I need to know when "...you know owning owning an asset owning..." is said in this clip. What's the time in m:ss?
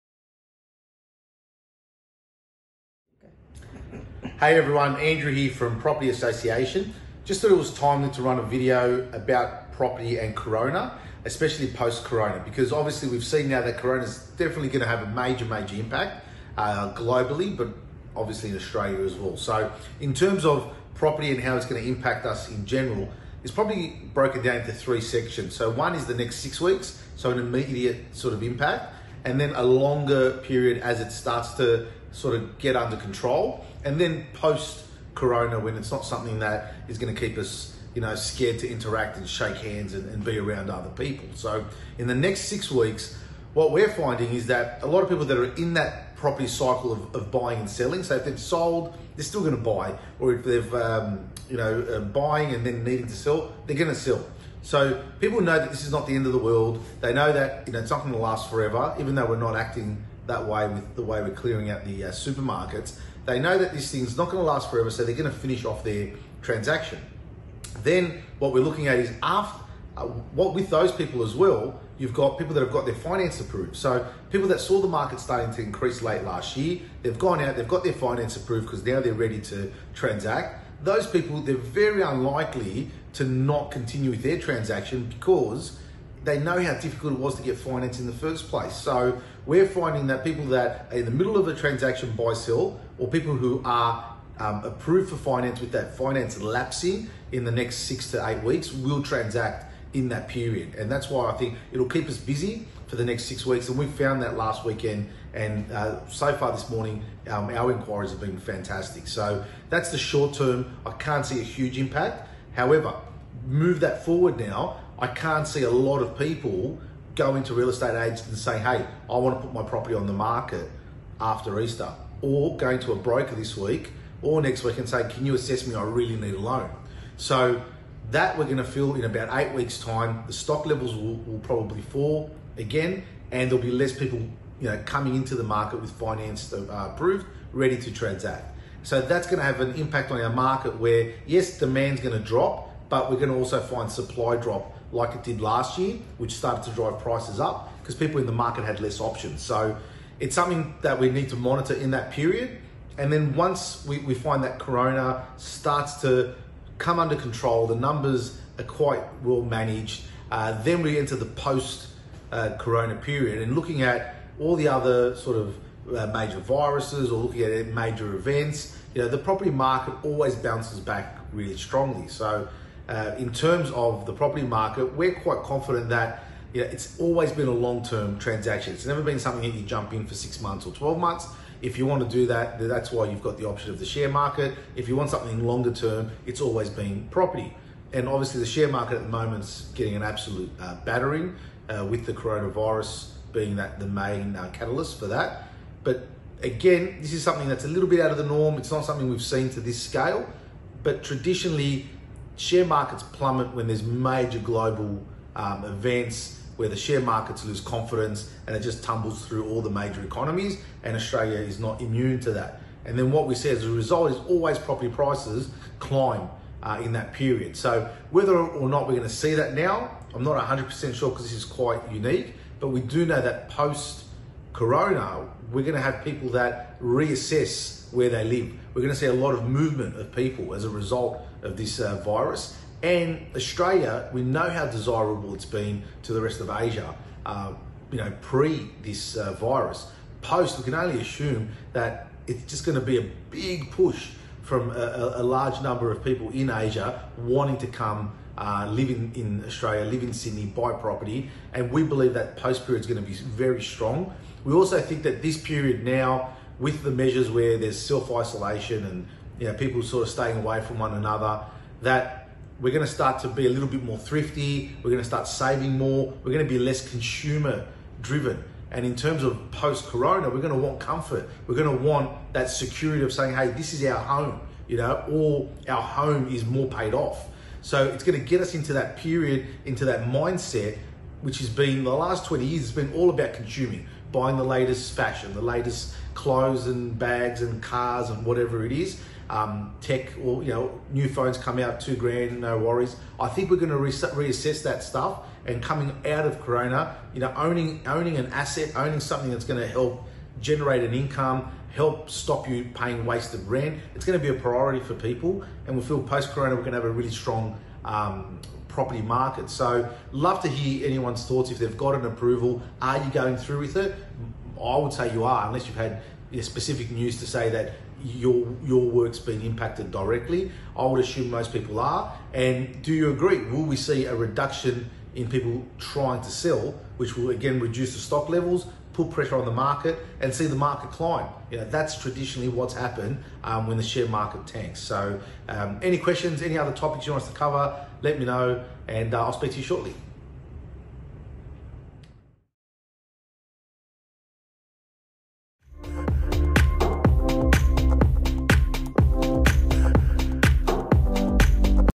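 4:57.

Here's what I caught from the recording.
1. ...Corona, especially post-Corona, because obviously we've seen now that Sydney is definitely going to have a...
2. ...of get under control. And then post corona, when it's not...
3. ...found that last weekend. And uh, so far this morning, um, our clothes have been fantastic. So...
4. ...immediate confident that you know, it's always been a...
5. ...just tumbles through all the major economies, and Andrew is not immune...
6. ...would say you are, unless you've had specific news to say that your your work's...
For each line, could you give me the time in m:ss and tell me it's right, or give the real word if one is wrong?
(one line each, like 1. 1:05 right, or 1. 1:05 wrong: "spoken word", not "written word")
1. 0:10 wrong: "Corona", not "Sydney"
2. 0:32 right
3. 1:43 wrong: "inquiries", not "clothes"
4. 2:55 wrong: "quite", not "immediate"
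5. 3:28 wrong: "Australia", not "Andrew"
6. 5:14 right.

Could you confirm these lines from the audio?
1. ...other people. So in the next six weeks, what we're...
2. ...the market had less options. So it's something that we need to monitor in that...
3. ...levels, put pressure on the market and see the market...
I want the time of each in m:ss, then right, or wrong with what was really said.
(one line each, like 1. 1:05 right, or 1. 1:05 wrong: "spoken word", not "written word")
1. 0:40 right
2. 2:28 right
3. 5:28 right.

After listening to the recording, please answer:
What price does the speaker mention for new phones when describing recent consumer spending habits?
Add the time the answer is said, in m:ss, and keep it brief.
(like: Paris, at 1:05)
2 grand, at 4:51.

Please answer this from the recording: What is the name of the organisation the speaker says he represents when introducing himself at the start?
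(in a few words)
Property Association.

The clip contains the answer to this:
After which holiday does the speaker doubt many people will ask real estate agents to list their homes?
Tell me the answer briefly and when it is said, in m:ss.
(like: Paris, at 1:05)
Easter, at 2:01.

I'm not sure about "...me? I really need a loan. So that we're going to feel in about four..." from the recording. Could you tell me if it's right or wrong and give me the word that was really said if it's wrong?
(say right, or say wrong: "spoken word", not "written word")
wrong: "eight", not "four".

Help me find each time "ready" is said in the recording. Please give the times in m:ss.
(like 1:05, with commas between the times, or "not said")
1:19, 2:17.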